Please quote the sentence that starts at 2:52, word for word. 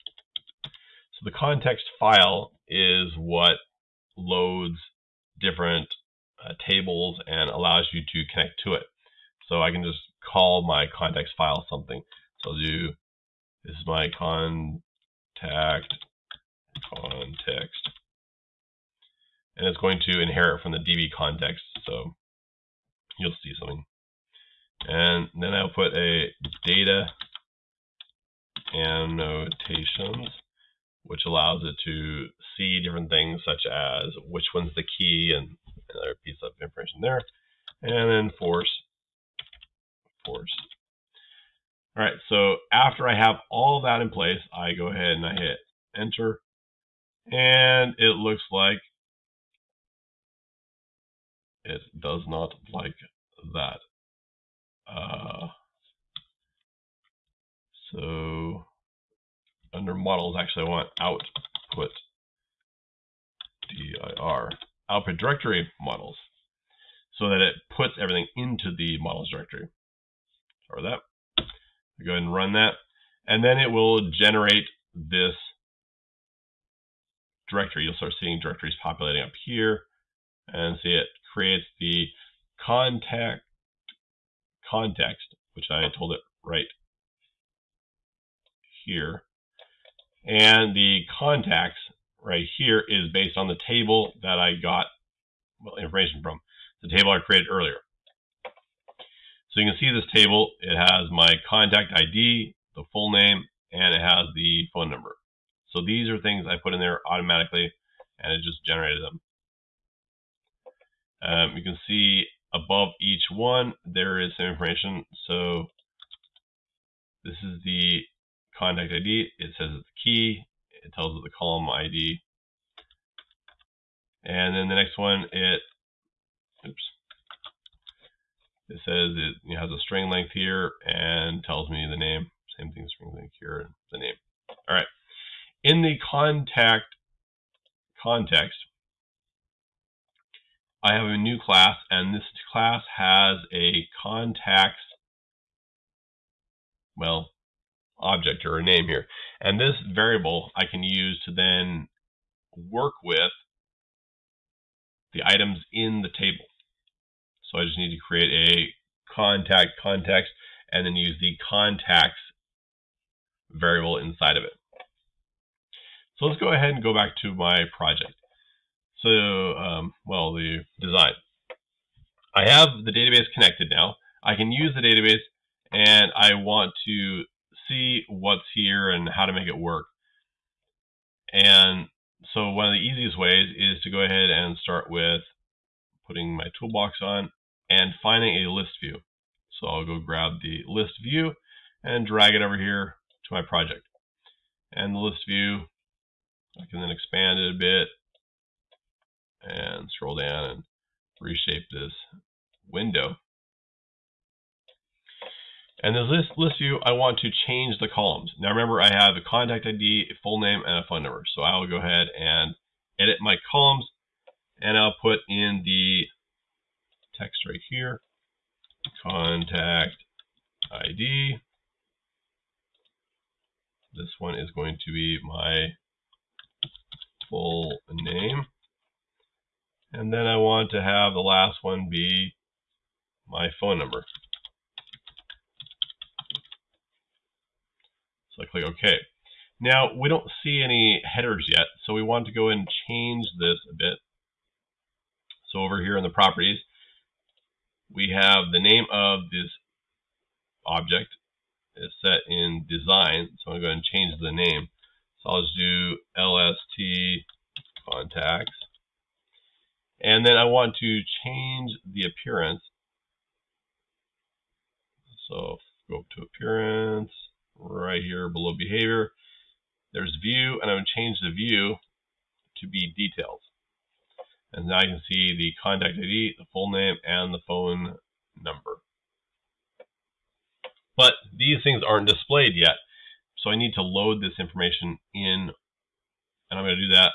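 I have the database connected now.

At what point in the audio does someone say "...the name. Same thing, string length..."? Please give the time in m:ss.
2:11.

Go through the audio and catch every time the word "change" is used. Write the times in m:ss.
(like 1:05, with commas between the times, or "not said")
3:27, 4:02, 4:13, 4:21, 4:30.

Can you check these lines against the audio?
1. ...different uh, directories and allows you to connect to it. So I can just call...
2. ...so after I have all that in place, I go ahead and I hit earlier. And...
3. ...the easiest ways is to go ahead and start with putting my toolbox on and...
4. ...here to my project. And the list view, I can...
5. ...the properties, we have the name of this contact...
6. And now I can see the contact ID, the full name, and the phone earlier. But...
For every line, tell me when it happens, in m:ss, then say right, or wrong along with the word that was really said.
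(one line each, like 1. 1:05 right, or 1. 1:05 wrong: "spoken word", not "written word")
1. 0:05 wrong: "tables", not "directories"
2. 0:42 wrong: "enter", not "earlier"
3. 3:02 right
4. 3:12 right
5. 4:06 wrong: "object", not "contact"
6. 4:34 wrong: "number", not "earlier".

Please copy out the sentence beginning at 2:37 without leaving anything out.
So I just need to create a contact context and then use the contacts variable inside of it.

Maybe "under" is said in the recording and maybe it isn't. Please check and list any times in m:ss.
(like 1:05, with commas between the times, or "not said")
0:59.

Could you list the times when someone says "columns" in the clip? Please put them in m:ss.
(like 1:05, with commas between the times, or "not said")
2:01, 3:27, 3:33.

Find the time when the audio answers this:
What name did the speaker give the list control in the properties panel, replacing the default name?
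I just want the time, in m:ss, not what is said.
4:16.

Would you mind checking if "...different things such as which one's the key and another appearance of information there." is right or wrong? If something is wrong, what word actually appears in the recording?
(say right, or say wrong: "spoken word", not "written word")
wrong: "piece", not "appearance".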